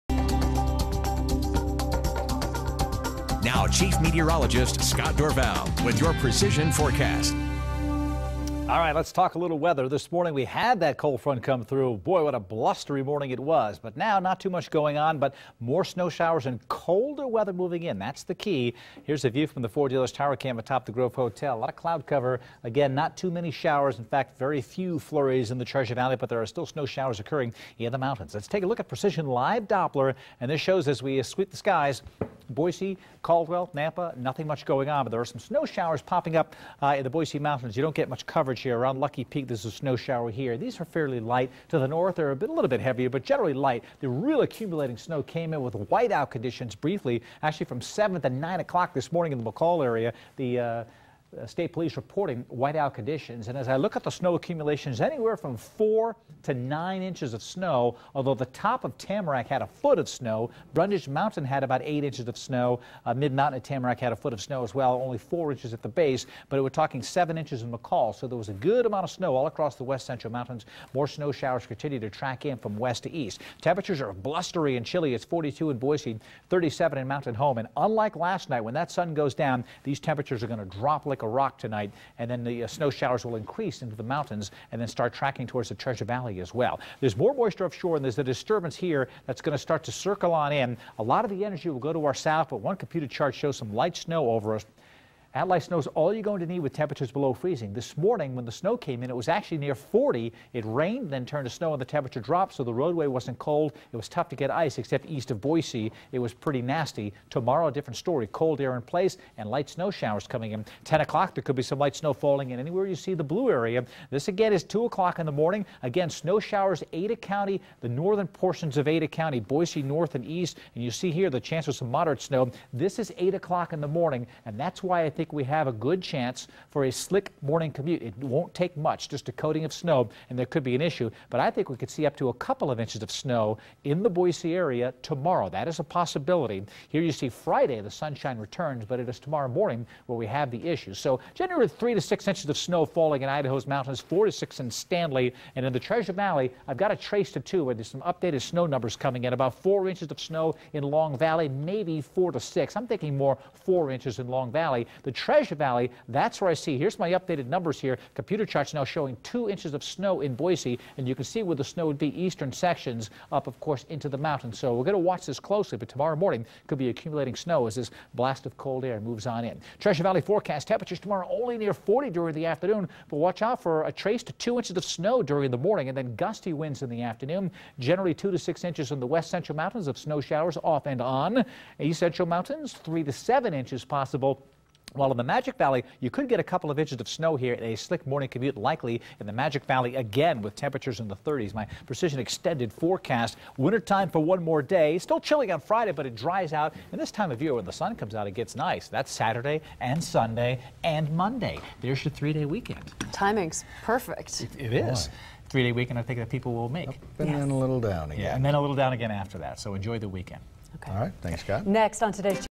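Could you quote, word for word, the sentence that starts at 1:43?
It was tough to get ice, except east of Boise.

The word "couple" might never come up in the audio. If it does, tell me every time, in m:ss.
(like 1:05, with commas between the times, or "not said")
2:12, 3:06.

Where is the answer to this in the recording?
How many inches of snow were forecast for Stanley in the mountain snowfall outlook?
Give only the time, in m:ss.
2:23.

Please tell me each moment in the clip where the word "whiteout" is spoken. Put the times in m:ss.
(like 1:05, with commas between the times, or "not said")
0:45, 0:52.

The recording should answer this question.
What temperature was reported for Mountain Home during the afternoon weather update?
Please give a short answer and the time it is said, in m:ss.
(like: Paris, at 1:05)
37, at 1:16.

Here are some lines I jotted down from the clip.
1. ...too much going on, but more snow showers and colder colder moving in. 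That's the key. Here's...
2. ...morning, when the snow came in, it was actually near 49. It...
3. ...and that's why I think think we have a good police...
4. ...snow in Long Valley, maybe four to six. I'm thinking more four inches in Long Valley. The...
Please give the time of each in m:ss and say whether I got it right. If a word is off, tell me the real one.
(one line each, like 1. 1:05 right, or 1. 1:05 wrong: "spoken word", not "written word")
1. 0:14 wrong: "weather", not "colder"
2. 1:37 wrong: "40", not "49"
3. 2:04 wrong: "chance", not "police"
4. 2:30 right.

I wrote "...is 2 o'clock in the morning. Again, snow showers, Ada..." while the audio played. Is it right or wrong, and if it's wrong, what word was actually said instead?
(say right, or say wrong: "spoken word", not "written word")
right.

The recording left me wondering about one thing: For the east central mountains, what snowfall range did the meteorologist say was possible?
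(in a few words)
3 to 7 inches.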